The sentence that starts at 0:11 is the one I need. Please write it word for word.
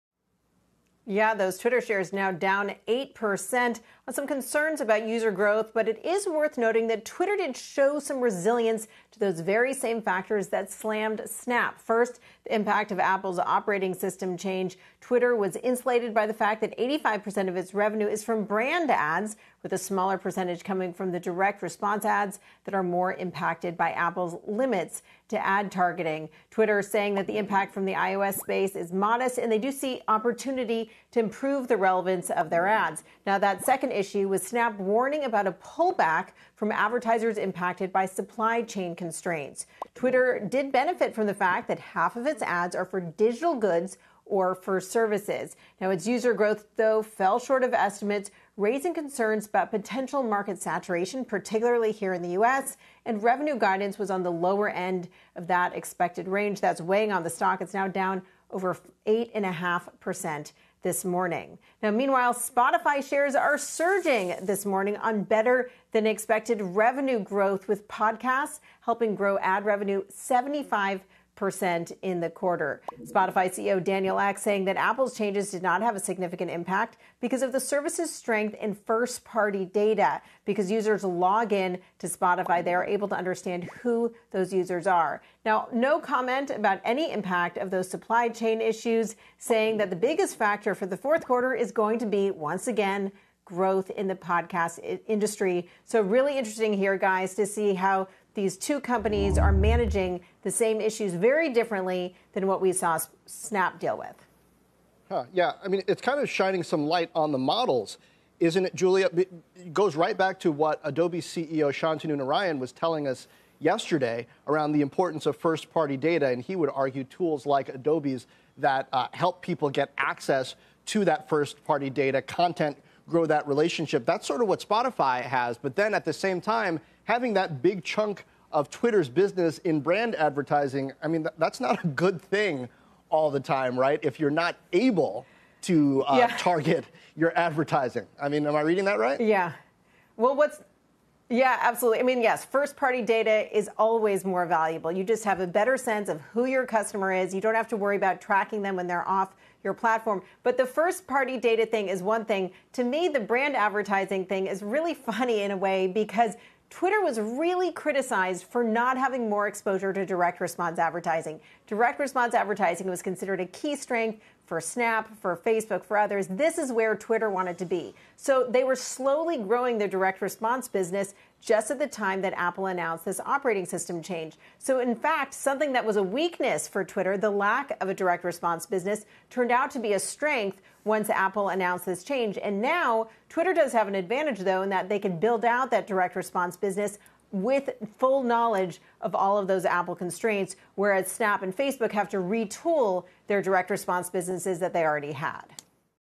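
First, the impact of Apple's operating system change.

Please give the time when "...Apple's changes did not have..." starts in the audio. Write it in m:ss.
1:14.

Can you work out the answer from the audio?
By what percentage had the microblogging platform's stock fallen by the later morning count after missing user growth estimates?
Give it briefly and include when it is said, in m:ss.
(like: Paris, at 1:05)
over 8.5%, at 0:58.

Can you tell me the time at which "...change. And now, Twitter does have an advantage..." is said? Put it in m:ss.
3:02.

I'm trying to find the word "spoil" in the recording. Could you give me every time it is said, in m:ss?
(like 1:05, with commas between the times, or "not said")
not said.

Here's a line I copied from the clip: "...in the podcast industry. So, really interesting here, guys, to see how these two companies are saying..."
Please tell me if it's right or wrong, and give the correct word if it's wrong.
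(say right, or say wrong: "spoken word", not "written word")
wrong: "managing", not "saying".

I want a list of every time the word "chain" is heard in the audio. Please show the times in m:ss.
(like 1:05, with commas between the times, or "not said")
0:38, 1:28.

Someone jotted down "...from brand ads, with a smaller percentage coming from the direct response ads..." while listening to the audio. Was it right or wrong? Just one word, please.
right.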